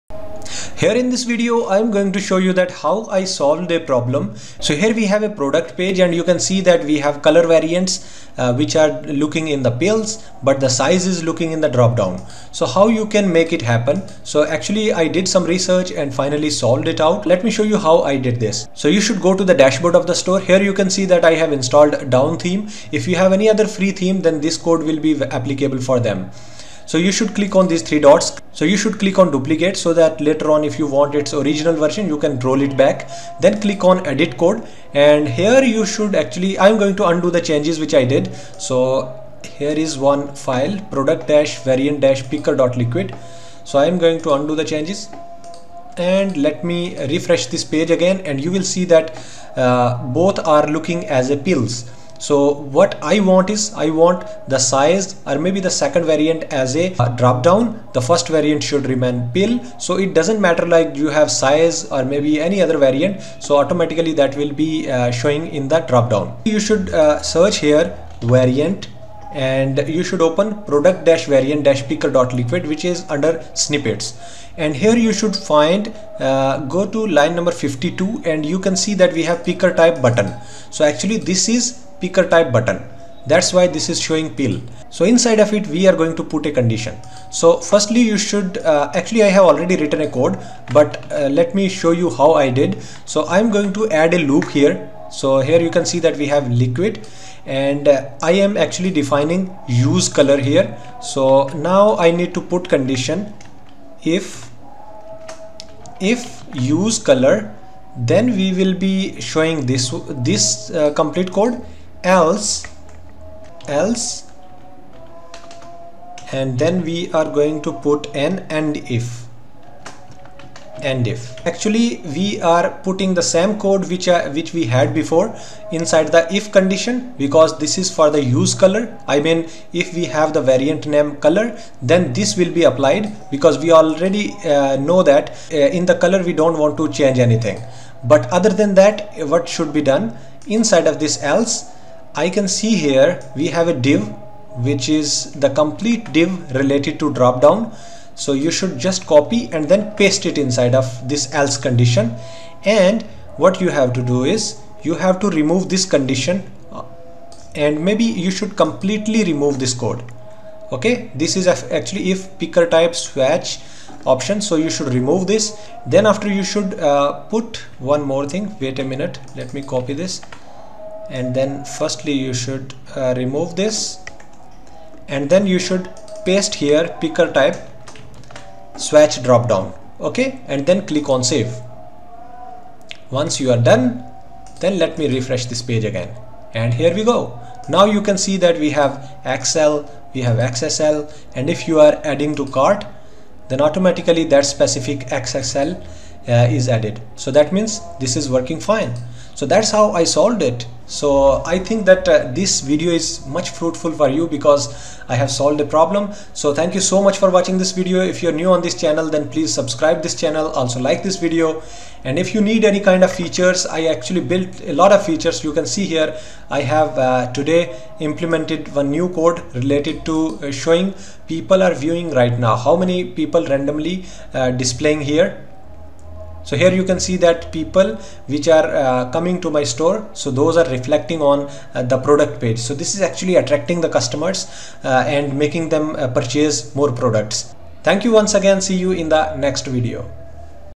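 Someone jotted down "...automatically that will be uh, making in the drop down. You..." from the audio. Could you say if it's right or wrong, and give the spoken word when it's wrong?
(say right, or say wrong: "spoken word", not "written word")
wrong: "showing", not "making".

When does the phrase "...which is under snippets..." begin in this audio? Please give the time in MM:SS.
01:12.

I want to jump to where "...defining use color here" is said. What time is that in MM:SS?
01:38.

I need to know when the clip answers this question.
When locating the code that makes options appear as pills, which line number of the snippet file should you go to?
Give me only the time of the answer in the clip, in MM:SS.
01:17.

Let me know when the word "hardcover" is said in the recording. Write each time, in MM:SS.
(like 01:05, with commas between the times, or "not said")
not said.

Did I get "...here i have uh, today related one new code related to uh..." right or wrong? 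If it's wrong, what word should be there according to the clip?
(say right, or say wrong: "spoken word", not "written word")
wrong: "implemented", not "related".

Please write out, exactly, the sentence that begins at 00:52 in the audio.
So what I want is I want the size or maybe the second variant as a uh, drop down.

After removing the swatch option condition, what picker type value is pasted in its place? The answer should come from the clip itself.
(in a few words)
swatch drop down.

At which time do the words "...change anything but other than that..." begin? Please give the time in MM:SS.
02:16.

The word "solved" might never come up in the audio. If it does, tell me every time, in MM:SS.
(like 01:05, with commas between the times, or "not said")
00:03, 00:16, 03:20, 03:25.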